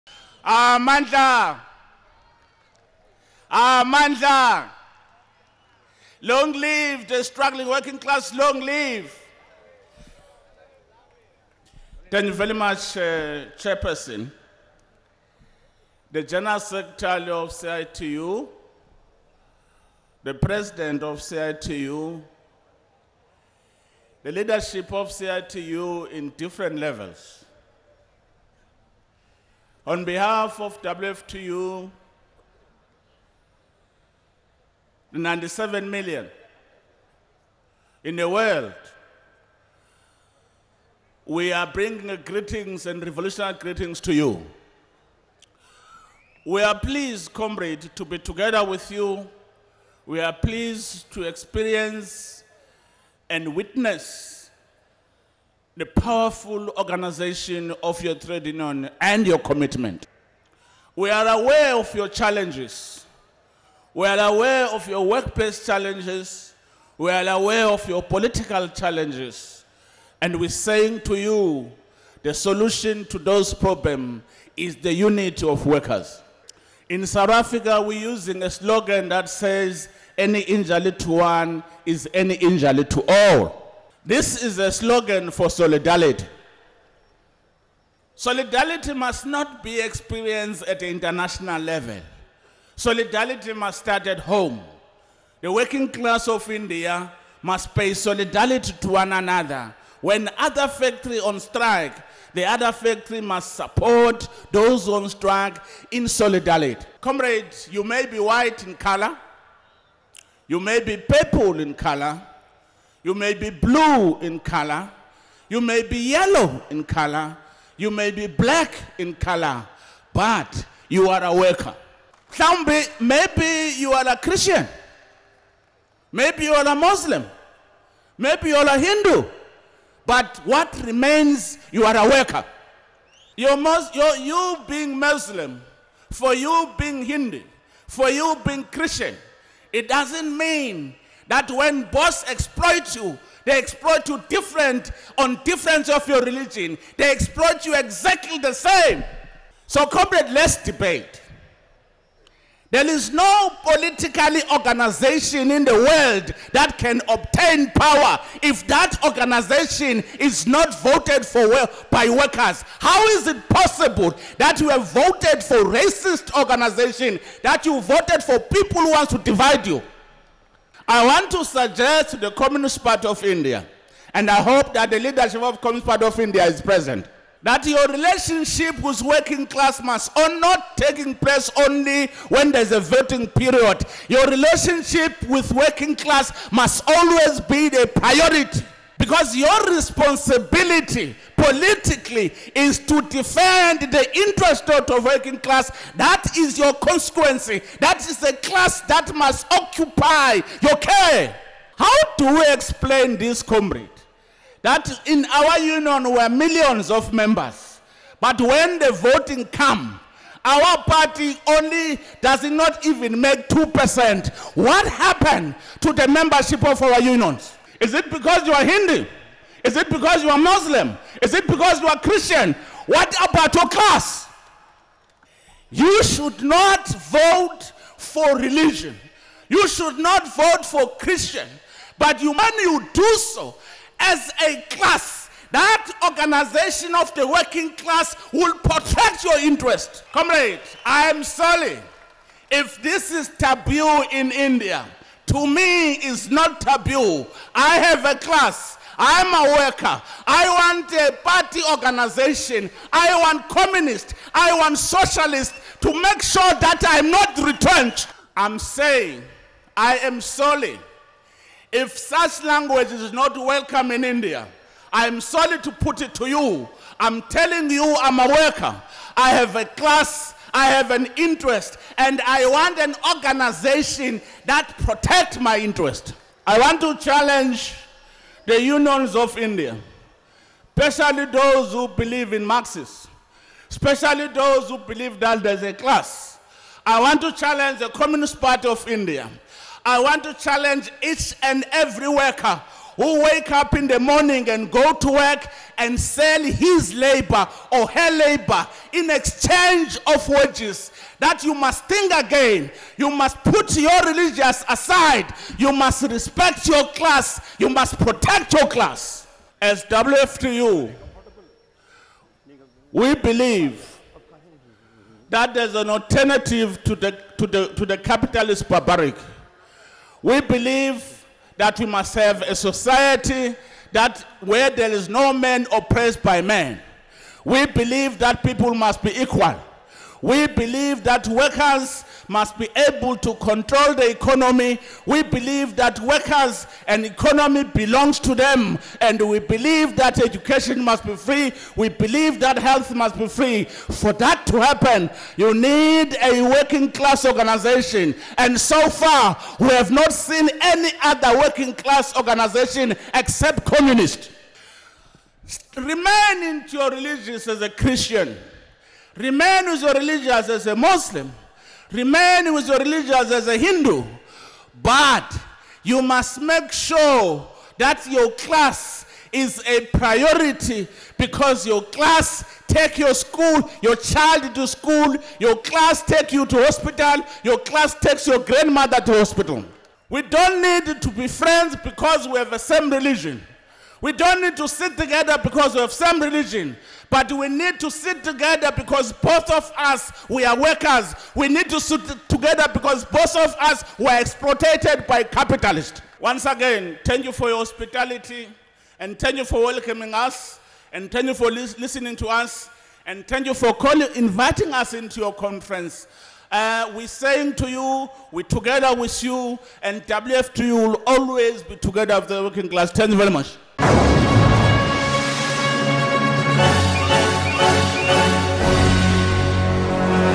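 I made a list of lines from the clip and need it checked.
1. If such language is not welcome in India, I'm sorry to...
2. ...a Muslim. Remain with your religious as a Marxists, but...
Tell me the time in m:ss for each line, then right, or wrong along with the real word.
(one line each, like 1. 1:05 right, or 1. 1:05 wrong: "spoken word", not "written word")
1. 4:21 right
2. 6:00 wrong: "Hindu", not "Marxists".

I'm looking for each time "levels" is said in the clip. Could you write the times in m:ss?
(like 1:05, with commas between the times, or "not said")
0:26, 1:31.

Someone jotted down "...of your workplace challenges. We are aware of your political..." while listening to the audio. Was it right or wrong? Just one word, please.
right.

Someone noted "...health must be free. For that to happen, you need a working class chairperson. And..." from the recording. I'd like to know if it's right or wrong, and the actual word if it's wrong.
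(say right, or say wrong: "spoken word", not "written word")
wrong: "organization", not "chairperson".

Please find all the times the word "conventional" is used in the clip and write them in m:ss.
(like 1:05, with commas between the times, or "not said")
not said.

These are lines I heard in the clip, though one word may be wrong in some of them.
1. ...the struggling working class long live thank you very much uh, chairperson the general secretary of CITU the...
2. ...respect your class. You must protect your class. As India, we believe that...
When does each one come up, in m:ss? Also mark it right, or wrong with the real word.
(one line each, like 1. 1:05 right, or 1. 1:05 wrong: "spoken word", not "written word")
1. 0:07 right
2. 5:06 wrong: "WFTU", not "India".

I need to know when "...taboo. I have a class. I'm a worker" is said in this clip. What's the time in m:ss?
4:06.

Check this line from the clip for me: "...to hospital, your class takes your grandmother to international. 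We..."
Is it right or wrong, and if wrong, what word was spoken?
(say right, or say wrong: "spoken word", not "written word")
wrong: "hospital", not "international".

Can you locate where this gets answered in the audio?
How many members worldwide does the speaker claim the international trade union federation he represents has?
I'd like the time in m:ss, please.
0:35.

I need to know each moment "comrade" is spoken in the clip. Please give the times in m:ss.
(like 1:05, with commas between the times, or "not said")
0:47, 1:47, 2:29, 3:23, 4:00.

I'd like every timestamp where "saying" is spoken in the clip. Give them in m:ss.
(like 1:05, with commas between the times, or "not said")
1:10, 4:18, 6:47.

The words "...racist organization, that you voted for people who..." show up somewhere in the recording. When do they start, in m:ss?
2:45.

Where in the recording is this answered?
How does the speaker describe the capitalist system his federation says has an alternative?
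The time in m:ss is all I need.
5:18.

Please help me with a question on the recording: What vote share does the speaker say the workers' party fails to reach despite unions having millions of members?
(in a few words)
2%.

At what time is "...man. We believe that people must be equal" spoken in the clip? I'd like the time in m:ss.
5:26.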